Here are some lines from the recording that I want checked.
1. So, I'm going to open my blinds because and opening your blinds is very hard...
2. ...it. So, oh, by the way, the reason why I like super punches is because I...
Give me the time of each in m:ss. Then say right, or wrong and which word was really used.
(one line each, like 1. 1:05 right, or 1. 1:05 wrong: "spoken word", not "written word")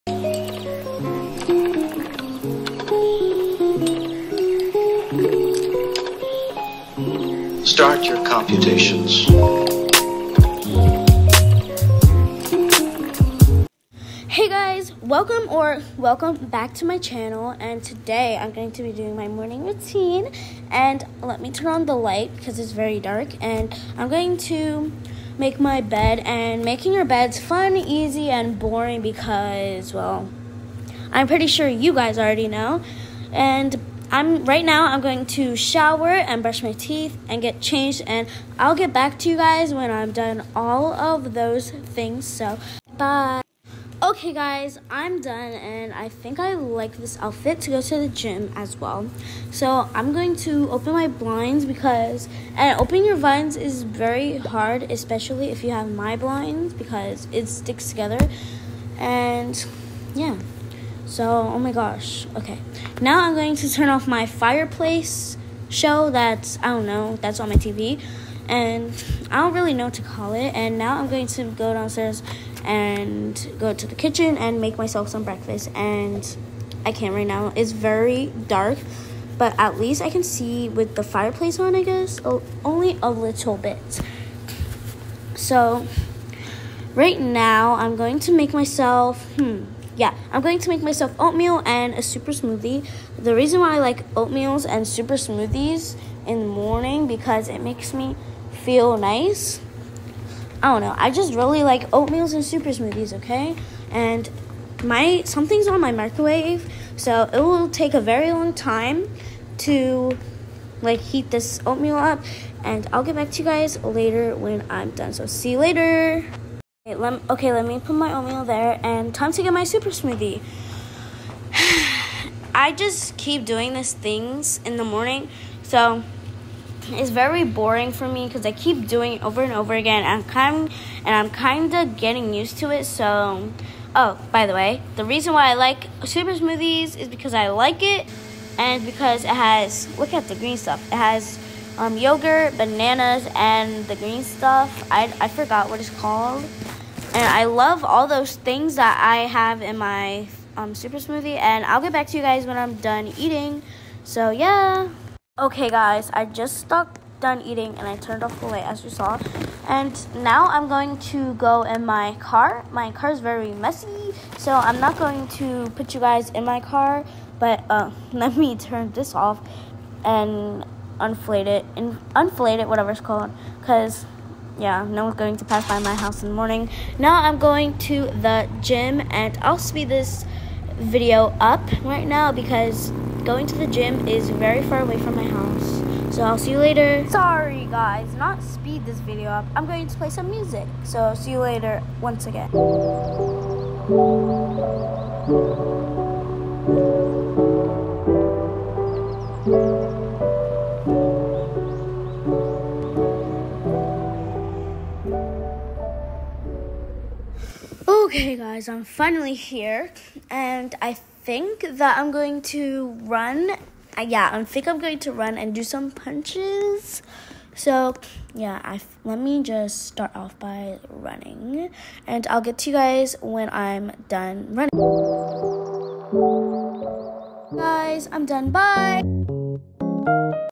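1. 0:49 right
2. 2:12 wrong: "smoothies", not "punches".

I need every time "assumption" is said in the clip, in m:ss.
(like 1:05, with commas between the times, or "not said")
not said.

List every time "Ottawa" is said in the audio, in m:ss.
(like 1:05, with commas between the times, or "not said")
not said.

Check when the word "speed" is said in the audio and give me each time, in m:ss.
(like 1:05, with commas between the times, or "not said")
2:59, 3:08.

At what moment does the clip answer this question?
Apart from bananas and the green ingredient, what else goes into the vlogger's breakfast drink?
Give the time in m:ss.
2:21.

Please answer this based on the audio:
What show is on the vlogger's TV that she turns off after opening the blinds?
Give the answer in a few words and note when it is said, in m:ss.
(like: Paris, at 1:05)
fireplace show, at 1:04.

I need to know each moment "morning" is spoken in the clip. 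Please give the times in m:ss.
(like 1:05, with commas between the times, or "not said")
0:19, 1:36, 2:04, 2:56.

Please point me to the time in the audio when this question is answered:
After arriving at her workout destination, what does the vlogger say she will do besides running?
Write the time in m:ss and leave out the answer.
3:35.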